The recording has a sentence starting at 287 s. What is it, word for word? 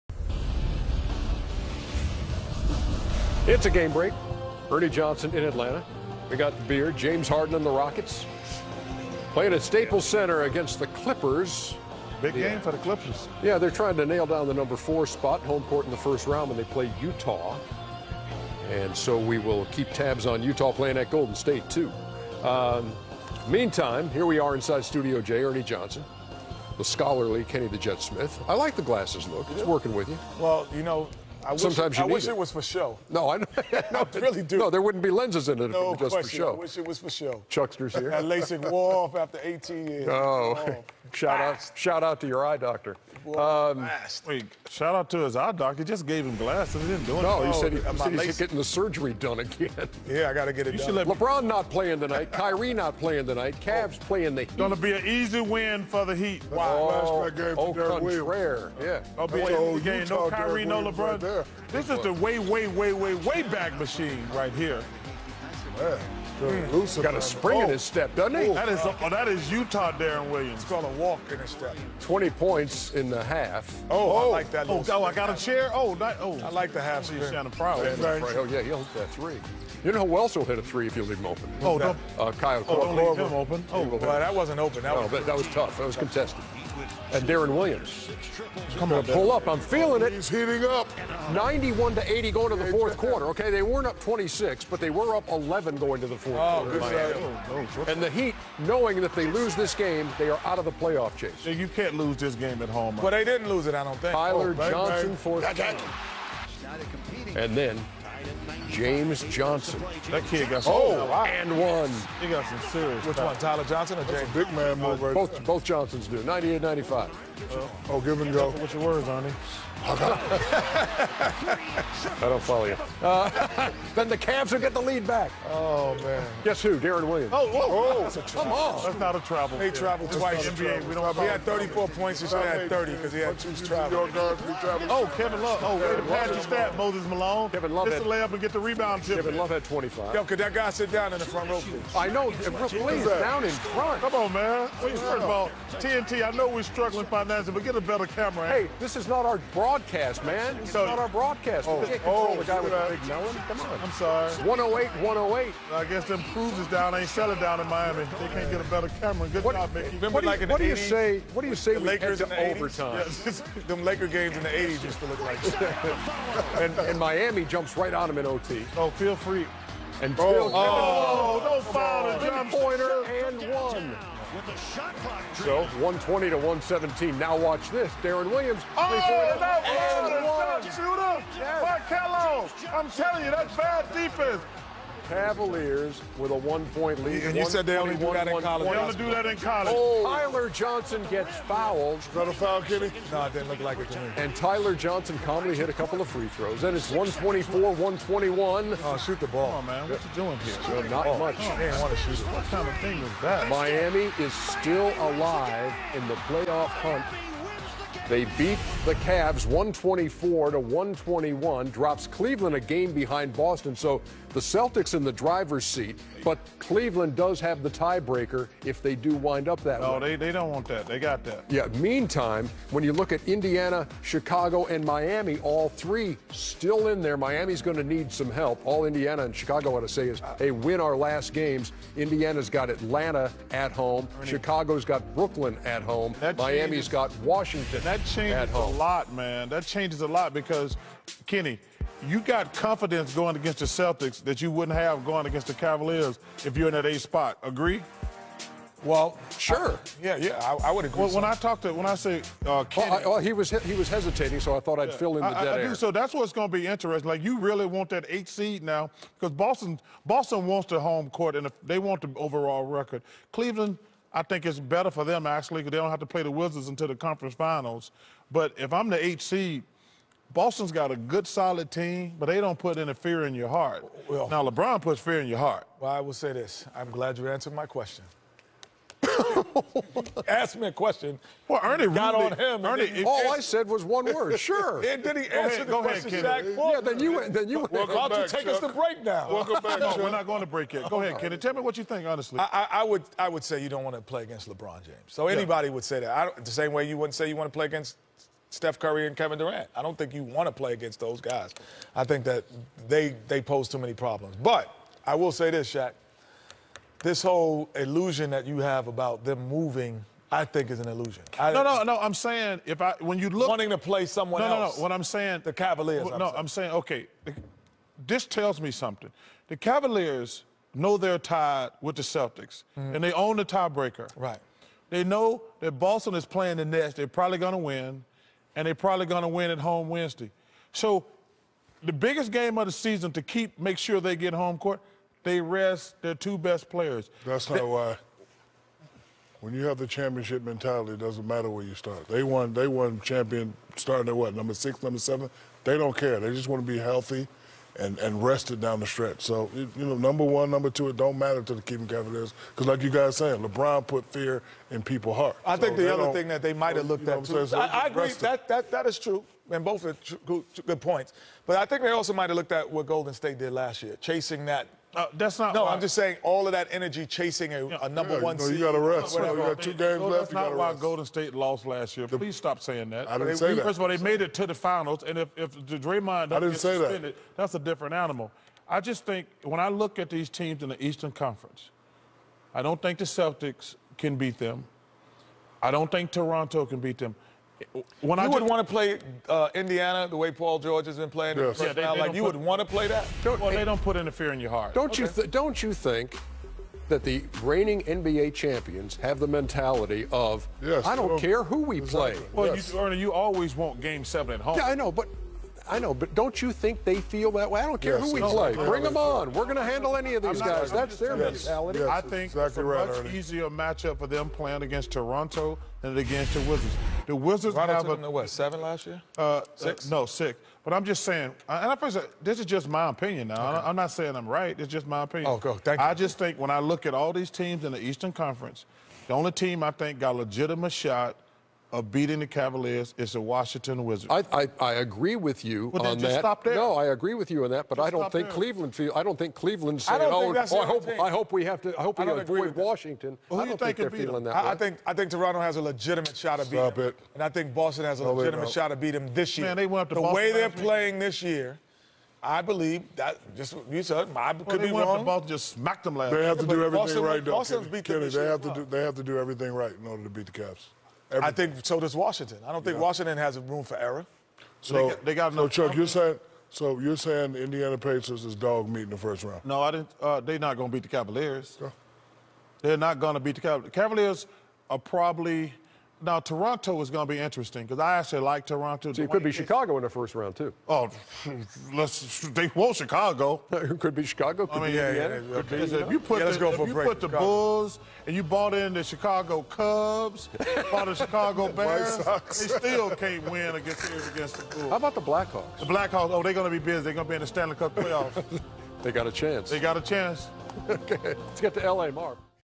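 Well, why don't you take Chuck.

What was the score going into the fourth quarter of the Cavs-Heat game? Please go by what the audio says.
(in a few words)
91 to 80.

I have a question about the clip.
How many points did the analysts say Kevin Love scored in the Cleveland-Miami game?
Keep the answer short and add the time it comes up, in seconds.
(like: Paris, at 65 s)
25, at 139 s.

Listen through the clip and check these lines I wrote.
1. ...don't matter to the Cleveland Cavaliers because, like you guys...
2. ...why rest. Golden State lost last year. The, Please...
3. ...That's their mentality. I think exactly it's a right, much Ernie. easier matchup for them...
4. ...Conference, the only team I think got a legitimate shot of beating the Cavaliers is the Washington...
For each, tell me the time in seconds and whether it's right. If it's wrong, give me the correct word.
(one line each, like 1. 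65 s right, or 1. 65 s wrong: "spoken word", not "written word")
1. 350 s right
2. 370 s right
3. 410 s right
4. 428 s right.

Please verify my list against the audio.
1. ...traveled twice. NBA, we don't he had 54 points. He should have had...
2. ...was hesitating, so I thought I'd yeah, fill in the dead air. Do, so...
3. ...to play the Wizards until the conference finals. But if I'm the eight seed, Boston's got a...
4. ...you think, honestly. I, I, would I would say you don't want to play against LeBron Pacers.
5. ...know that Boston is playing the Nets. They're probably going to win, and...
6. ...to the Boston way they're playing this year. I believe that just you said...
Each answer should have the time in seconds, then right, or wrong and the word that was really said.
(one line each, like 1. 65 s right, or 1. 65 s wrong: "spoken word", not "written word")
1. 129 s wrong: "34", not "54"
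2. 253 s right
3. 266 s right
4. 291 s wrong: "James", not "Pacers"
5. 325 s right
6. 449 s right.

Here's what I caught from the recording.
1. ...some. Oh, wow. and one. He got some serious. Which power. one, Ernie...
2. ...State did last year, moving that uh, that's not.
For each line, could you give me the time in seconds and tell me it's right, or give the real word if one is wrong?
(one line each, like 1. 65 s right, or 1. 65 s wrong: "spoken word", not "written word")
1. 110 s wrong: "Tyler", not "Ernie"
2. 363 s wrong: "chasing", not "moving".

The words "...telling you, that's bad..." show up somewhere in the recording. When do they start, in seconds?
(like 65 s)
182 s.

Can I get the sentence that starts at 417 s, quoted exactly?
The Wizards Toronto have a, seven last year?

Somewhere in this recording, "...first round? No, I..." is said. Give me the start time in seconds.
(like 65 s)
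468 s.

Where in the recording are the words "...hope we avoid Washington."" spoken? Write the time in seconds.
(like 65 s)
441 s.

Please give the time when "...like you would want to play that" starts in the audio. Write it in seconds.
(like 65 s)
391 s.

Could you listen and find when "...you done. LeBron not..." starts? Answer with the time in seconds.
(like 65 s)
50 s.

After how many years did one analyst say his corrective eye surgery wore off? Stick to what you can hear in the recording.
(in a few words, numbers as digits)
18.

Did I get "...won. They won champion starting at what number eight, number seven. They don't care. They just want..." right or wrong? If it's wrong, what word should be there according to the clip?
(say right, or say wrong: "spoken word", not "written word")
wrong: "six", not "eight".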